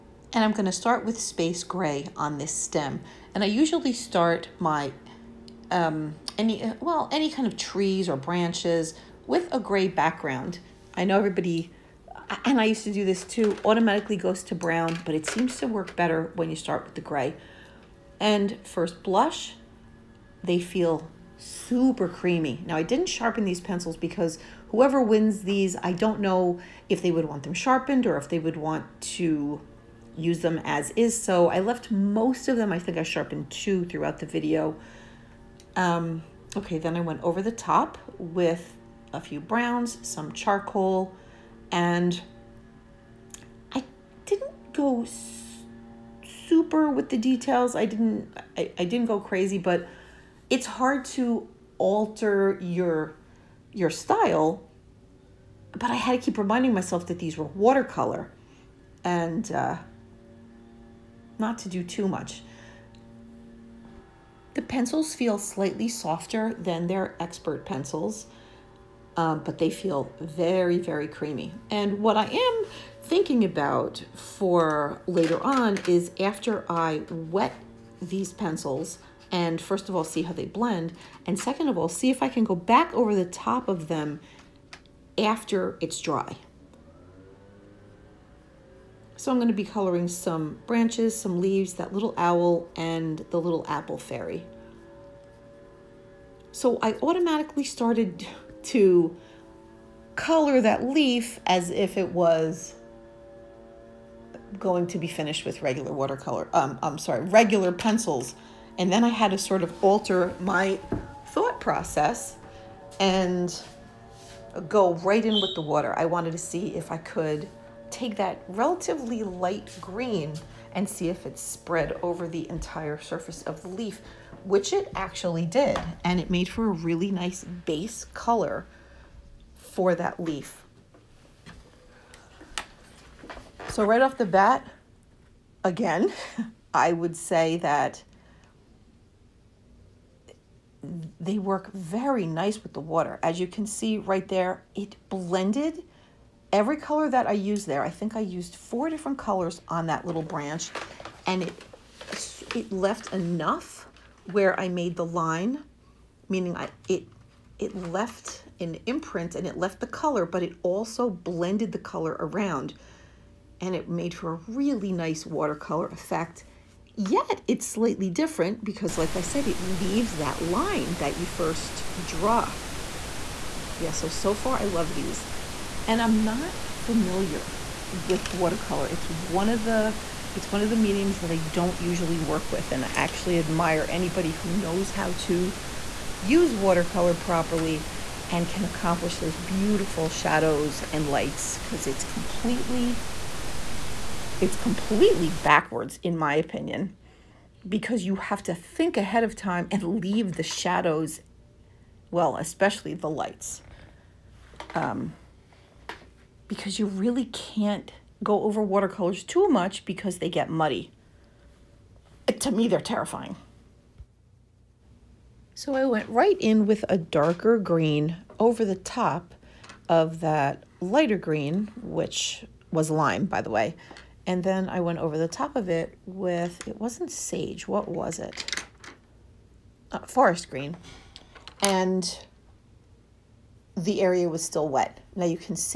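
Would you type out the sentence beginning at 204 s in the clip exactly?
Um, because you really can't go over watercolors too much because they get muddy.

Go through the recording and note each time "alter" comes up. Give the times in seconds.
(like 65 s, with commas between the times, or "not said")
51 s, 109 s.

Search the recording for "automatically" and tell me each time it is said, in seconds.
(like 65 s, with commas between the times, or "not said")
13 s, 97 s.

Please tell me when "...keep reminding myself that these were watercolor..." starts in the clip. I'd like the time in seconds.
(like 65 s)
56 s.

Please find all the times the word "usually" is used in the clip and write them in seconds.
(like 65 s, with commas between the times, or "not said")
3 s, 181 s.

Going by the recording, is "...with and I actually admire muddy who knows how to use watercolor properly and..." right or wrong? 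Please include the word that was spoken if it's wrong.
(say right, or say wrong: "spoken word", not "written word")
wrong: "anybody", not "muddy".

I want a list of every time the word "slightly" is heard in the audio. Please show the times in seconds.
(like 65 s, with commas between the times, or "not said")
65 s, 167 s.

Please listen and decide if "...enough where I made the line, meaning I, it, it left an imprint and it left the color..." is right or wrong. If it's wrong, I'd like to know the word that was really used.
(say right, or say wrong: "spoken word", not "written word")
right.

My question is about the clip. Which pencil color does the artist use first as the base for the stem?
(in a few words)
Space gray.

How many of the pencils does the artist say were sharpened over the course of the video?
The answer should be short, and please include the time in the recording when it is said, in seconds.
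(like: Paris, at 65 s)
2, at 33 s.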